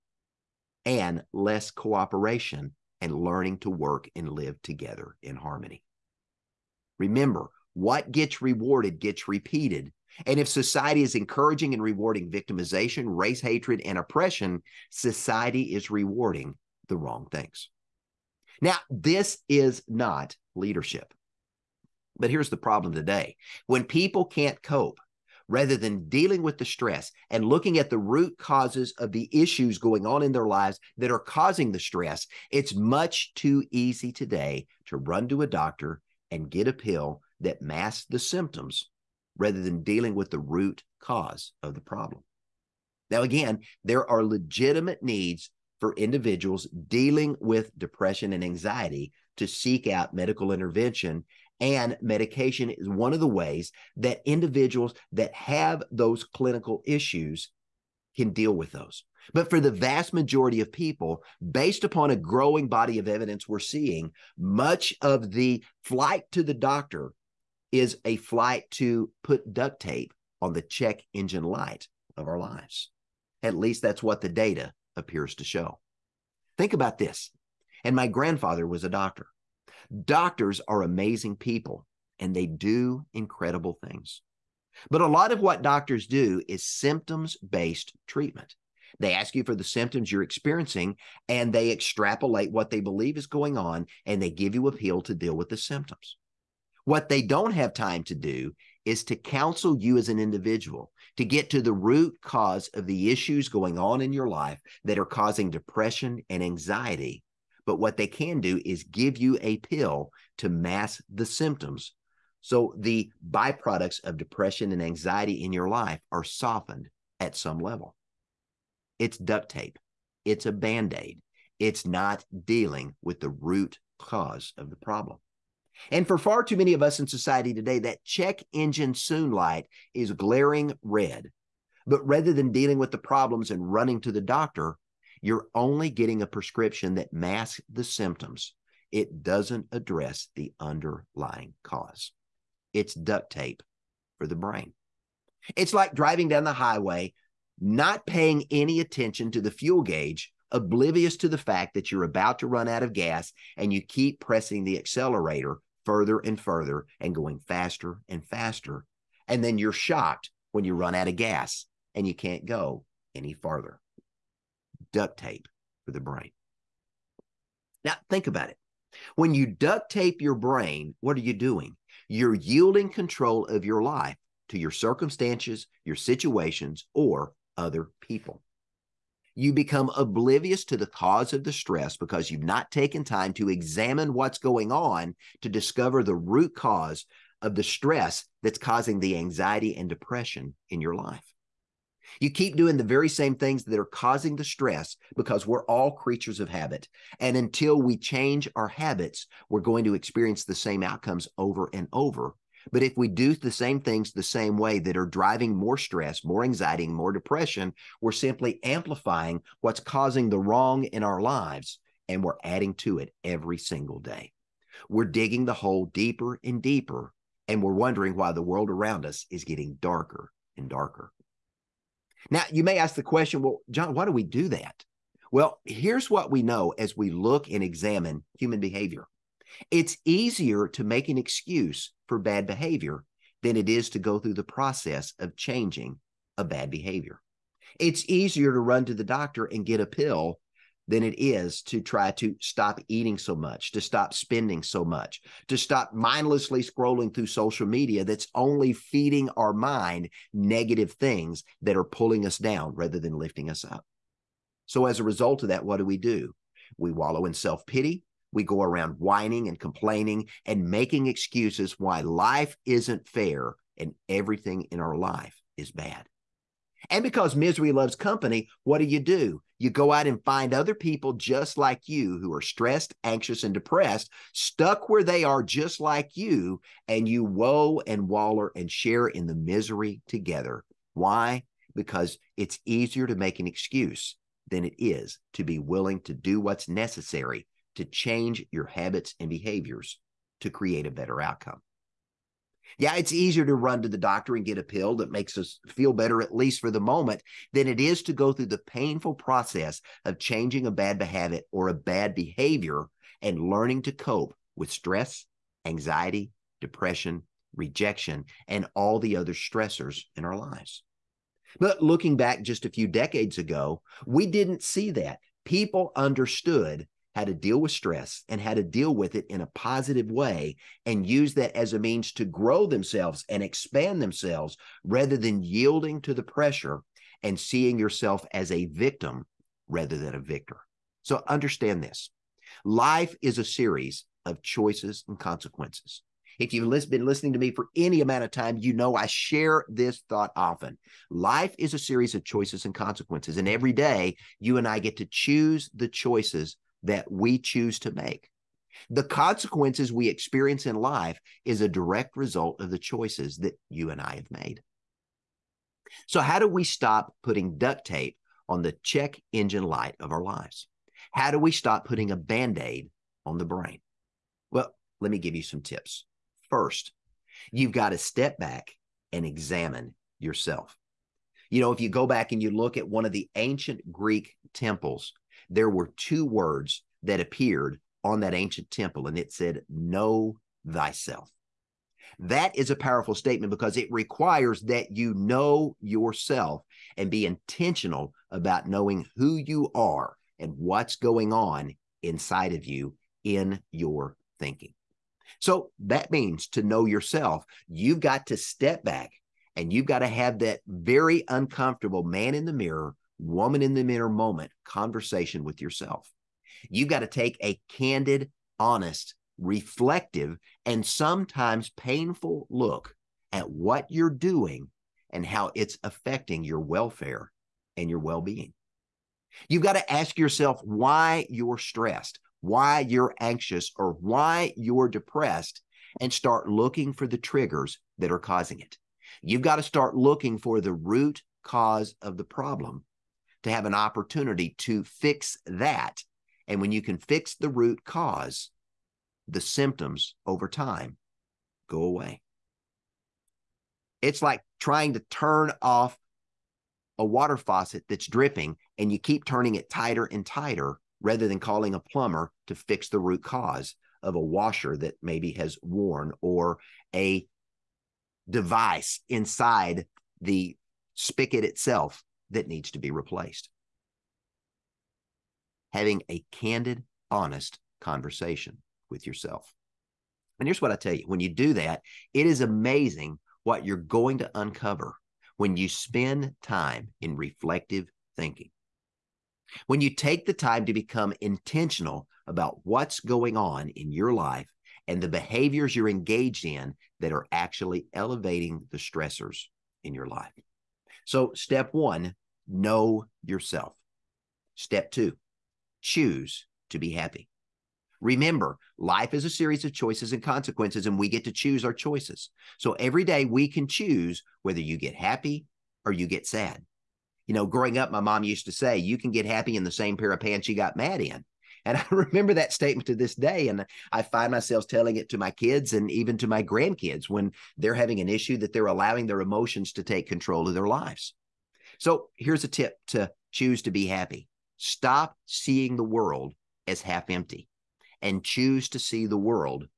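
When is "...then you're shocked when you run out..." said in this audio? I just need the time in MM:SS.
02:39.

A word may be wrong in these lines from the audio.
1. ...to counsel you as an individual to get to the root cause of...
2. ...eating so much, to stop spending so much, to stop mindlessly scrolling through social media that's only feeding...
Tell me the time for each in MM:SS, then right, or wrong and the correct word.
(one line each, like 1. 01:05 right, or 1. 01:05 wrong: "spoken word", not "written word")
1. 01:39 right
2. 04:02 right.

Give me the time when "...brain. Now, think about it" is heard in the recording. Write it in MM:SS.
02:45.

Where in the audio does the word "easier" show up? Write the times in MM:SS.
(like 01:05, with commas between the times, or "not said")
03:50, 03:58, 04:42, 04:53.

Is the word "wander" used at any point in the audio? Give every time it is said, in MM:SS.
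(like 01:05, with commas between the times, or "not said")
not said.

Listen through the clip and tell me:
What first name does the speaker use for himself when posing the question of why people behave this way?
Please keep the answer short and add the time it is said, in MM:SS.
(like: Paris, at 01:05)
John, at 03:43.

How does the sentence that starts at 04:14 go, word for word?
So, as a result of that, what do we do?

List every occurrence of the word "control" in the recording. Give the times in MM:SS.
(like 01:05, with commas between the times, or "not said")
02:52, 08:40.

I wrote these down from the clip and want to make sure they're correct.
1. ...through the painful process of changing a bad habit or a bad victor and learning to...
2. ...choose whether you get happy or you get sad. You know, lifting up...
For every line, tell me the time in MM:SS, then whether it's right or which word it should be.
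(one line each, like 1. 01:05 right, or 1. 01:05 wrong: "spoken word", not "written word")
1. 04:58 wrong: "behavior", not "victor"
2. 08:23 wrong: "growing", not "lifting".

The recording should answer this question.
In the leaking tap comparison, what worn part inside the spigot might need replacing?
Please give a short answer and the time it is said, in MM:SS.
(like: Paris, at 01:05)
A washer, at 07:34.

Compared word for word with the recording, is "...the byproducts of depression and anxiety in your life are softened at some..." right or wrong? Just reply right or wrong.
right.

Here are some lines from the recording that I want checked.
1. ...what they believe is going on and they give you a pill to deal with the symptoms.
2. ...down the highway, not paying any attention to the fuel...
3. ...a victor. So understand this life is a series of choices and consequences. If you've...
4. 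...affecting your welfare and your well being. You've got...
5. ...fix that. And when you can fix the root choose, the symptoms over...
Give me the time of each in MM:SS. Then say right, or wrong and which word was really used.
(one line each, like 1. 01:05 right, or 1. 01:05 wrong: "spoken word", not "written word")
1. 01:32 right
2. 02:26 right
3. 05:30 right
4. 06:55 right
5. 07:14 wrong: "cause", not "choose".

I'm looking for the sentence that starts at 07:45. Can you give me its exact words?
Having a candid, honest conversation with yourself.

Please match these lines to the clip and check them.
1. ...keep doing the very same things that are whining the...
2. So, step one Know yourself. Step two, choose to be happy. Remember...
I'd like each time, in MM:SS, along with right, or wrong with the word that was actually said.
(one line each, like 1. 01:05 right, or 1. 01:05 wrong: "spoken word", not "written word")
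1. 03:12 wrong: "causing", not "whining"
2. 08:11 right.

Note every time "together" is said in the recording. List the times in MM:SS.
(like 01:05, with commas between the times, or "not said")
00:04, 04:40.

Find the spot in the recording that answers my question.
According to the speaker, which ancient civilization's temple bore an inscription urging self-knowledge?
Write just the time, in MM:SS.
06:13.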